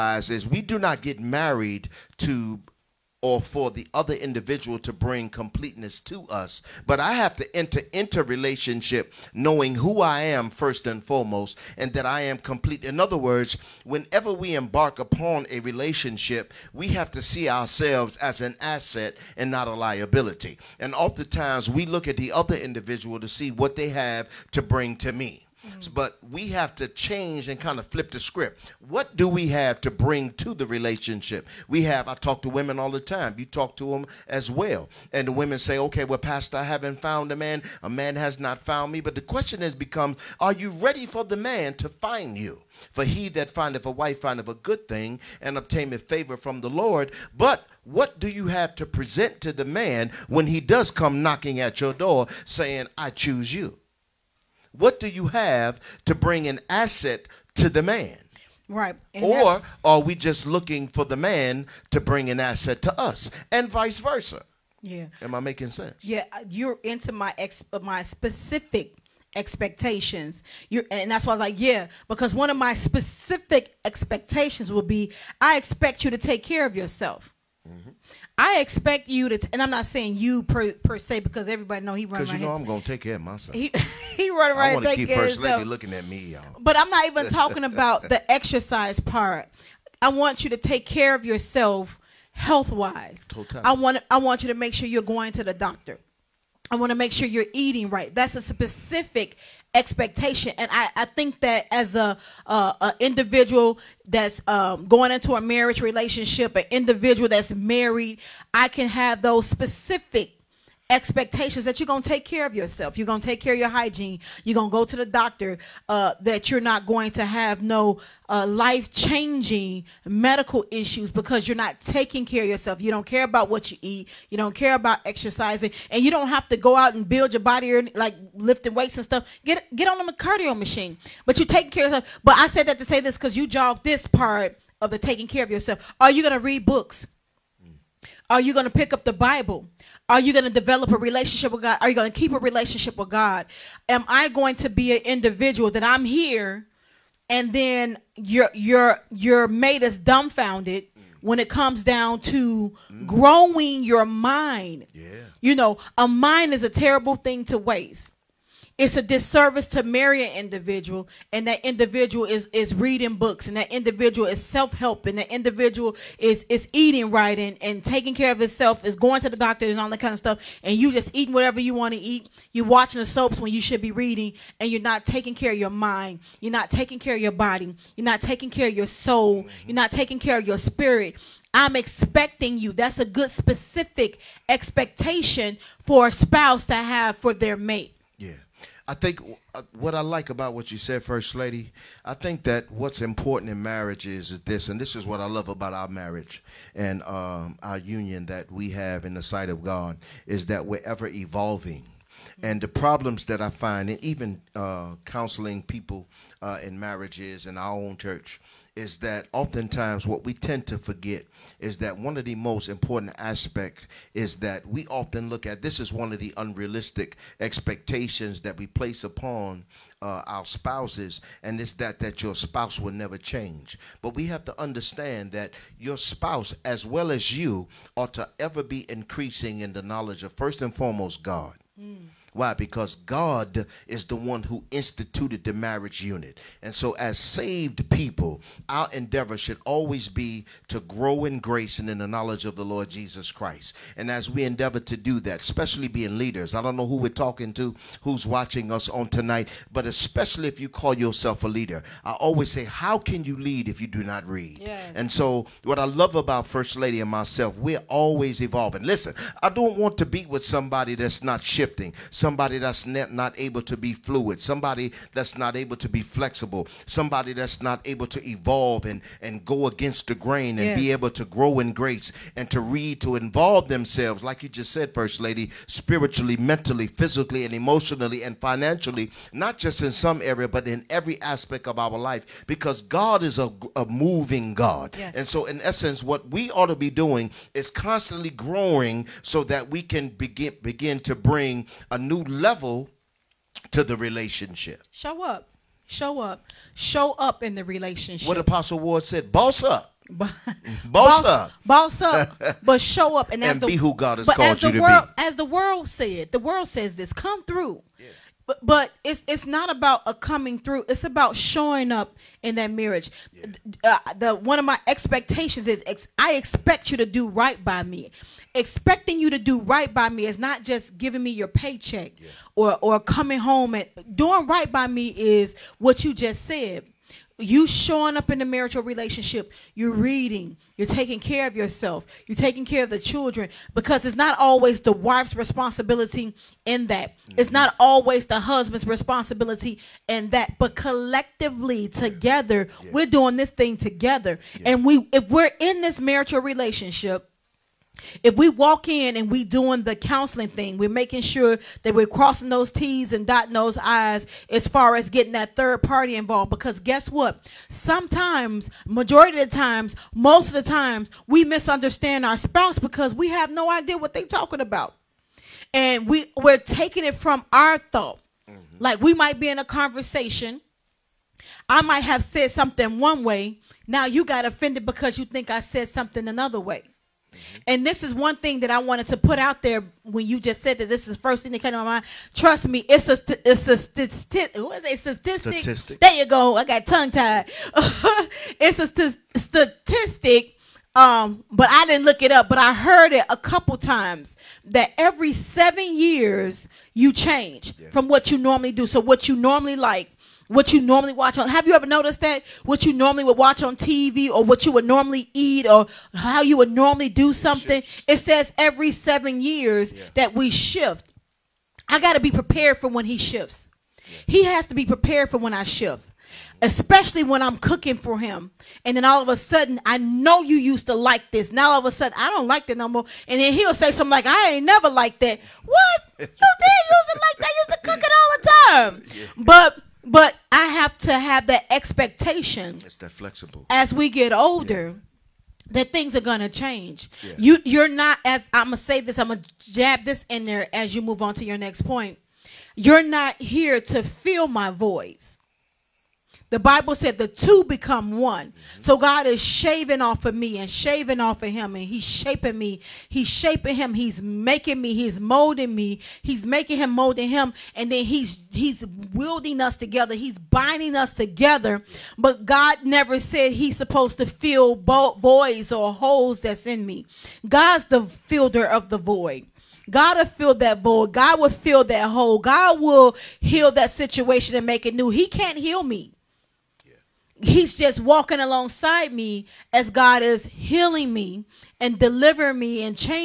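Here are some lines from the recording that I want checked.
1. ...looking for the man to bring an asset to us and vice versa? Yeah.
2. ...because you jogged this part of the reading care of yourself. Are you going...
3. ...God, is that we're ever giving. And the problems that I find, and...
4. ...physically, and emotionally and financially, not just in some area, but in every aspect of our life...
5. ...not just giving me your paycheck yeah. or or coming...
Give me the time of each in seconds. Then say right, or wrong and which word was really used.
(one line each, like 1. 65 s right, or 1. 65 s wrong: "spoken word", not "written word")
1. 60 s right
2. 133 s wrong: "taking", not "reading"
3. 199 s wrong: "evolving", not "giving"
4. 276 s right
5. 320 s right.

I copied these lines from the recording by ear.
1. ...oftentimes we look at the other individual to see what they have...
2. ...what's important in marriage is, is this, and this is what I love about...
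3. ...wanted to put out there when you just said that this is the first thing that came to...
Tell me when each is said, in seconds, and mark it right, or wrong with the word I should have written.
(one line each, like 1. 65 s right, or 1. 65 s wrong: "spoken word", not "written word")
1. 20 s right
2. 192 s right
3. 378 s right.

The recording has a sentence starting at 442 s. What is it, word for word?
You're not here to fill my voice.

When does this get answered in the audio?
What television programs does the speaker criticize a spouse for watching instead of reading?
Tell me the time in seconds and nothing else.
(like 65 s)
172 s.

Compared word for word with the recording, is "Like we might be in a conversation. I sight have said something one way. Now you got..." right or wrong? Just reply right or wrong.
wrong.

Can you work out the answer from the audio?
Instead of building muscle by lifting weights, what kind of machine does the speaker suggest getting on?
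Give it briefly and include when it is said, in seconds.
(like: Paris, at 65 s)
cardio machine, at 130 s.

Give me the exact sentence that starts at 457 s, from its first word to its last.
And then he's he's wielding us together.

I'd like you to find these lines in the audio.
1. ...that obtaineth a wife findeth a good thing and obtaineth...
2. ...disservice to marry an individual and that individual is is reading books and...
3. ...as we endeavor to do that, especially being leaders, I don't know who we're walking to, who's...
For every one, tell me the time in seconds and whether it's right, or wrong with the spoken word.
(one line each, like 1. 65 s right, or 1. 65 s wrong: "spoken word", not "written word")
1. 43 s wrong: "findeth", not "obtaineth"
2. 159 s right
3. 244 s wrong: "talking", not "walking".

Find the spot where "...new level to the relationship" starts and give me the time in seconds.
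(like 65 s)
292 s.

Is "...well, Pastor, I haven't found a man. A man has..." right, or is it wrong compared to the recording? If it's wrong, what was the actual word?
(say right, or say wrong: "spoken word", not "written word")
right.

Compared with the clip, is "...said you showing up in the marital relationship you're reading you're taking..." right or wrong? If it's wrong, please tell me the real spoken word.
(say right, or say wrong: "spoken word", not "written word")
right.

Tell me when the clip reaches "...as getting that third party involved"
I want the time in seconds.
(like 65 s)
354 s.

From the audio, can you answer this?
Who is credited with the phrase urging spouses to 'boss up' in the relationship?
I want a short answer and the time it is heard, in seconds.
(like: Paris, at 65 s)
Apostle Ward, at 298 s.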